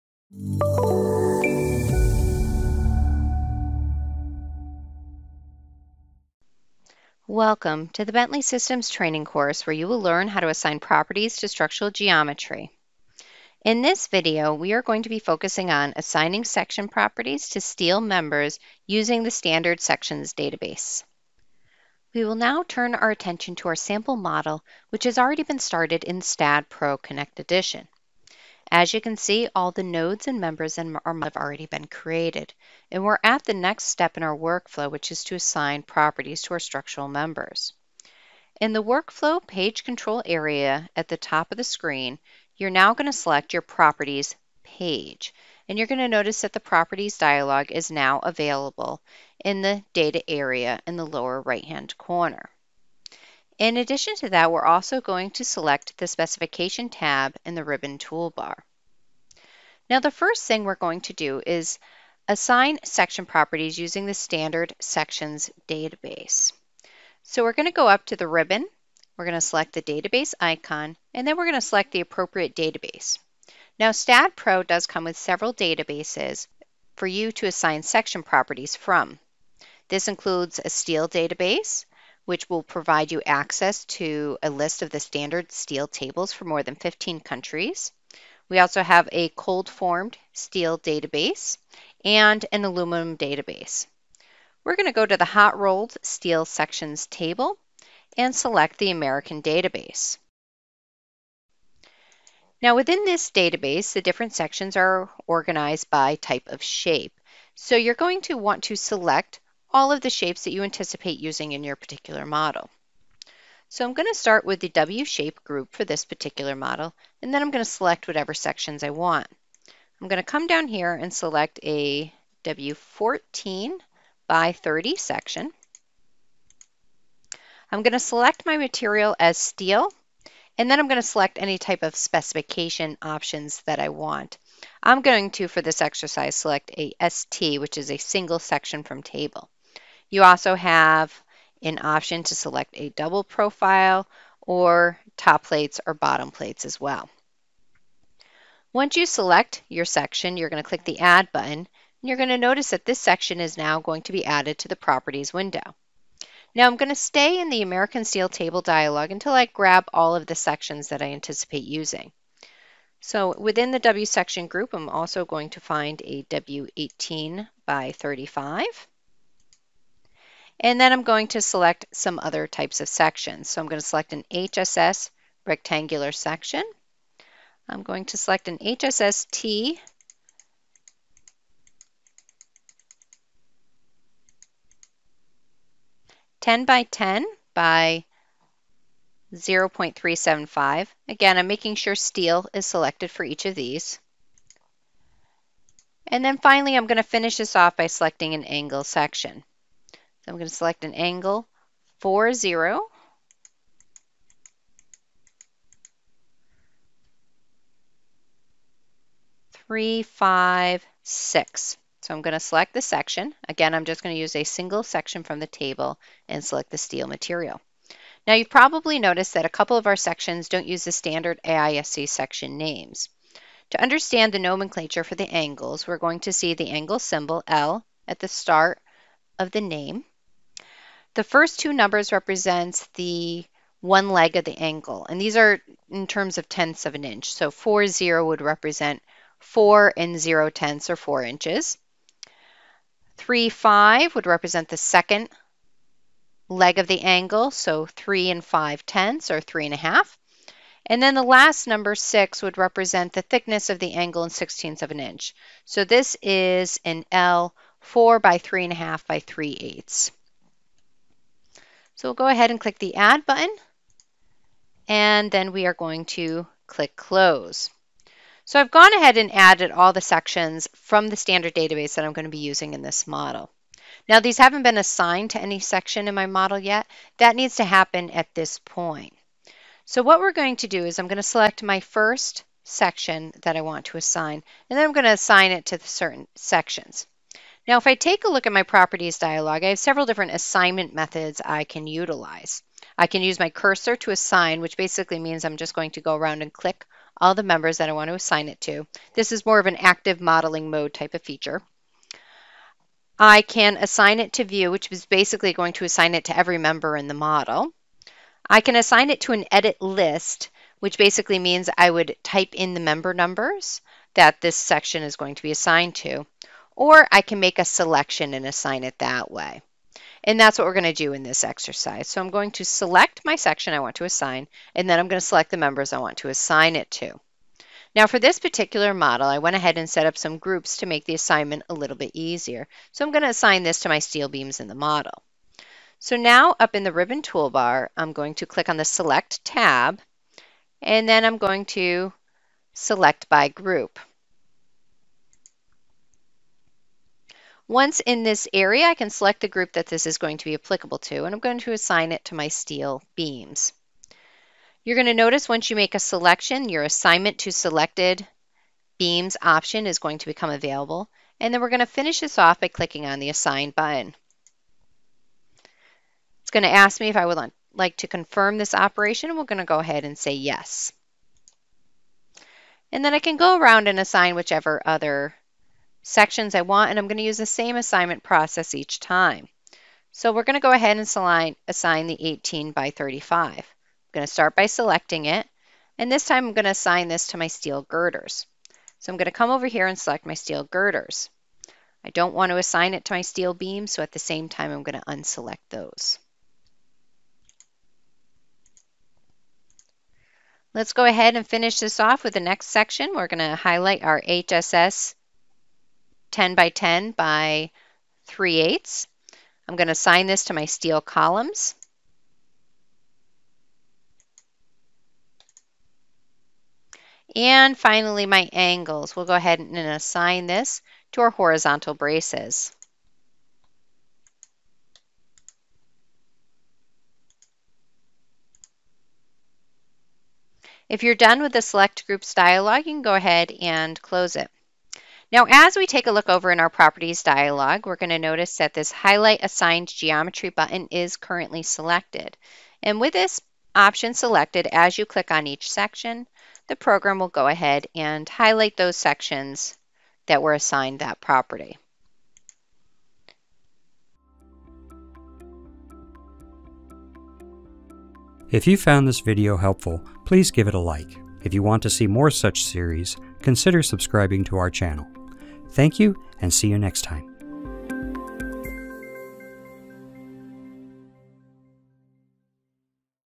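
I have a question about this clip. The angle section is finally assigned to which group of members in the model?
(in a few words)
horizontal braces.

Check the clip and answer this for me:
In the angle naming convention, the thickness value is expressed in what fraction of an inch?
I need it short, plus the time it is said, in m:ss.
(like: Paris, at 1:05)
sixteenths, at 4:14.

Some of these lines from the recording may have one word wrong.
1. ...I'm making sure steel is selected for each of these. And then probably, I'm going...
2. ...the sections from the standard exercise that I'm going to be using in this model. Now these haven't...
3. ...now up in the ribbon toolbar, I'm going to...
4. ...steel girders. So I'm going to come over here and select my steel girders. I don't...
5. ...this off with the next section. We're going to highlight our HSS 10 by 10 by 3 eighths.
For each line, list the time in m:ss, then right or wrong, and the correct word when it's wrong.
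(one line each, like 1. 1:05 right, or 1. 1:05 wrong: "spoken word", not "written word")
1. 3:11 wrong: "finally", not "probably"
2. 4:29 wrong: "database", not "exercise"
3. 5:36 right
4. 6:27 right
5. 6:41 right.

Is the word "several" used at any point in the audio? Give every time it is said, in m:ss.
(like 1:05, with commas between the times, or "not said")
1:15, 4:49.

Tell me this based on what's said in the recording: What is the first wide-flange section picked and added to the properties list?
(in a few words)
W14 by 30.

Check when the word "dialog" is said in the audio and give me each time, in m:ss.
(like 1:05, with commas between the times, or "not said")
0:47, 2:38, 4:49, 7:12, 7:17.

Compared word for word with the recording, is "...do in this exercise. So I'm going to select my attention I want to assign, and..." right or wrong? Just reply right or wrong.
wrong.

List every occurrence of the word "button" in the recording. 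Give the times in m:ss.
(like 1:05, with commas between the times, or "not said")
2:31, 4:23, 6:03, 7:20.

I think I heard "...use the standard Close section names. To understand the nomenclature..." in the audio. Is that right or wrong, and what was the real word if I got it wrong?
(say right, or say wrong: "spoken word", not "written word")
wrong: "AISC", not "Close".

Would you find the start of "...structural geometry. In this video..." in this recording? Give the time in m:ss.
0:11.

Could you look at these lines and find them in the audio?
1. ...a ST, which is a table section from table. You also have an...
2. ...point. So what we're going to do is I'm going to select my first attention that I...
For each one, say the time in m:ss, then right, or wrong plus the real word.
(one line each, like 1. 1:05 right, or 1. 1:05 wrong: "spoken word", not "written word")
1. 2:16 wrong: "single", not "table"
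2. 4:38 wrong: "section", not "attention".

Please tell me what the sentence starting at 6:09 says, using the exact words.
And we're going to go ahead and say yes.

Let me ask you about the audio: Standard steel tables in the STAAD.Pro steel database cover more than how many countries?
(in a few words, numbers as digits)
15.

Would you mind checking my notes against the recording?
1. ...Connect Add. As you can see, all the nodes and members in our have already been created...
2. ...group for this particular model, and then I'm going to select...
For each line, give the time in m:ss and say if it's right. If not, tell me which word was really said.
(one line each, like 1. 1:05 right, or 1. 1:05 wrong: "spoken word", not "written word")
1. 0:26 wrong: "Edition", not "Add"
2. 1:55 right.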